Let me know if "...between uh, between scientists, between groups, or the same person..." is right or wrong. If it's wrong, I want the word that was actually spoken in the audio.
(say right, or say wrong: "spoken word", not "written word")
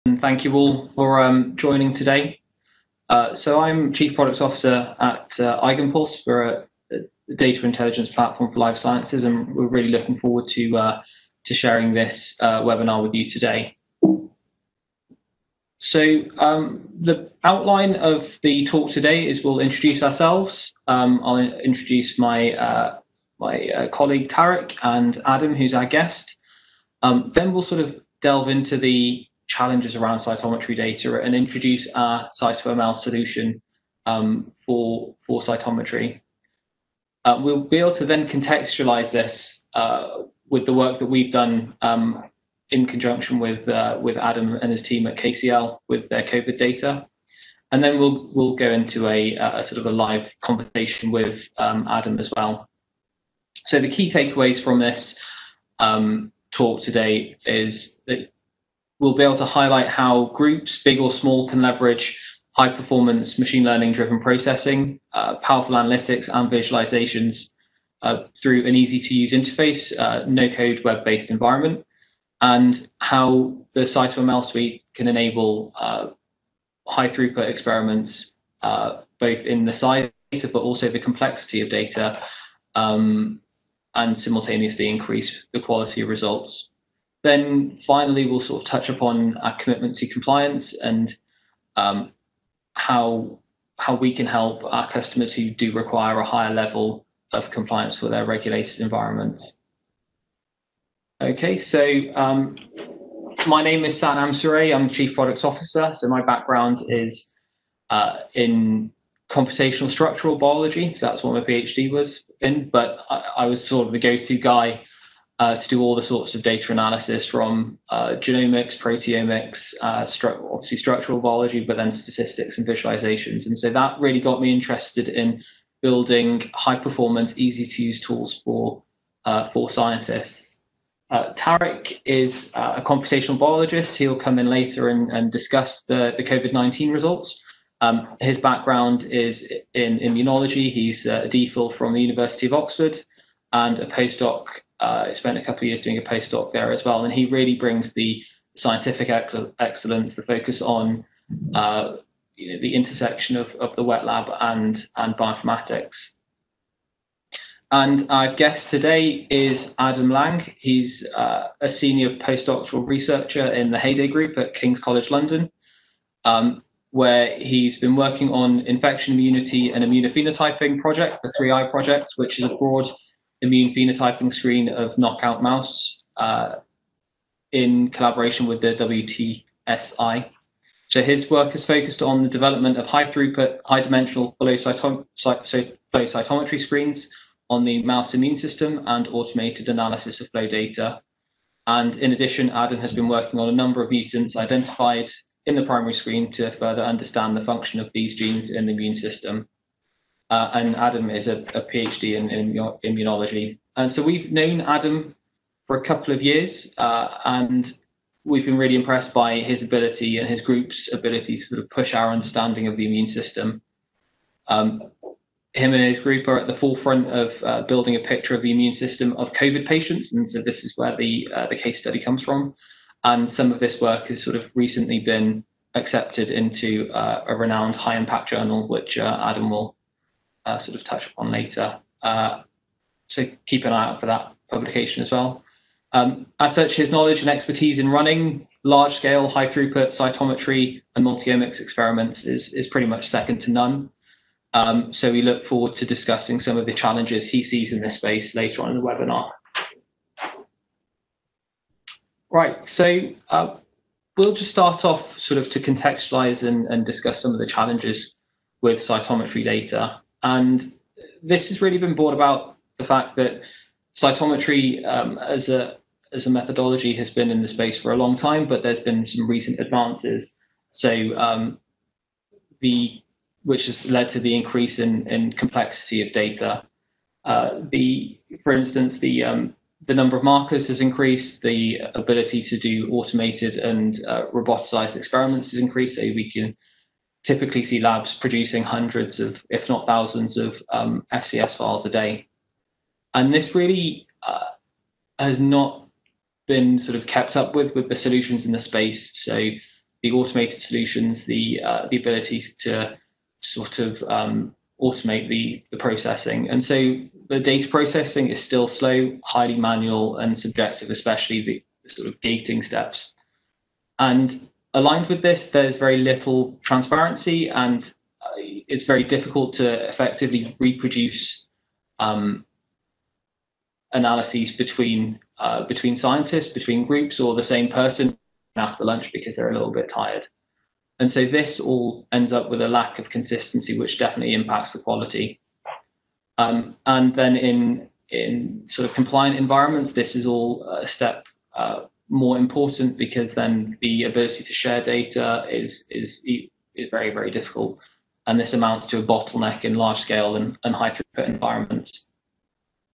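right.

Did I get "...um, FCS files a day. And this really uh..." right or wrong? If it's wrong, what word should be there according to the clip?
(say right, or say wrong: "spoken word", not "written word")
right.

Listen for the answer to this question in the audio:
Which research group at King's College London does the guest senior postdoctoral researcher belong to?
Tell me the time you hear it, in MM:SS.
02:43.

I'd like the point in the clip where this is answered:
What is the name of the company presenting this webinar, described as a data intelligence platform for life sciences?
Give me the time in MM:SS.
00:05.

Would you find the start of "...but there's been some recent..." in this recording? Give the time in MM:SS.
04:28.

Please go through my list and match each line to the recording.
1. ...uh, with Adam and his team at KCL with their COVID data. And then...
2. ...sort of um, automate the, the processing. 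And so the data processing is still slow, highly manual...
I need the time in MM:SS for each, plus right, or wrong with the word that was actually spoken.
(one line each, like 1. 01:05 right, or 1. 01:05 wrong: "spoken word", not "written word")
1. 00:43 right
2. 05:03 right.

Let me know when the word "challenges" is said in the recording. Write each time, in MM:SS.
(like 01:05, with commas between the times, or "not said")
00:29, 04:06, 04:17.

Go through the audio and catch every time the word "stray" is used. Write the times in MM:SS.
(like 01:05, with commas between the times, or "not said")
not said.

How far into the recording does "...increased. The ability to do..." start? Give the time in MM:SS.
04:40.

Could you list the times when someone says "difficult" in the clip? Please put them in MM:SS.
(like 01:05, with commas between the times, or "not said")
05:19, 05:47.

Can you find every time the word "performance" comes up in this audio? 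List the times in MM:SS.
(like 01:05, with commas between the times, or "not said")
01:02, 02:06.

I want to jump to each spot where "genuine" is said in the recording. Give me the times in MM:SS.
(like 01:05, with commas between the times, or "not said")
not said.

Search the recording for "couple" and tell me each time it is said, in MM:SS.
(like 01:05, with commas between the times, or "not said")
02:25, 03:25.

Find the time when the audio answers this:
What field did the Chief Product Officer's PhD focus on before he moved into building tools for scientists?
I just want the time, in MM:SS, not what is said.
01:49.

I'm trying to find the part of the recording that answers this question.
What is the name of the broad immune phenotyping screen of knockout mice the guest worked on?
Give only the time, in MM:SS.
02:51.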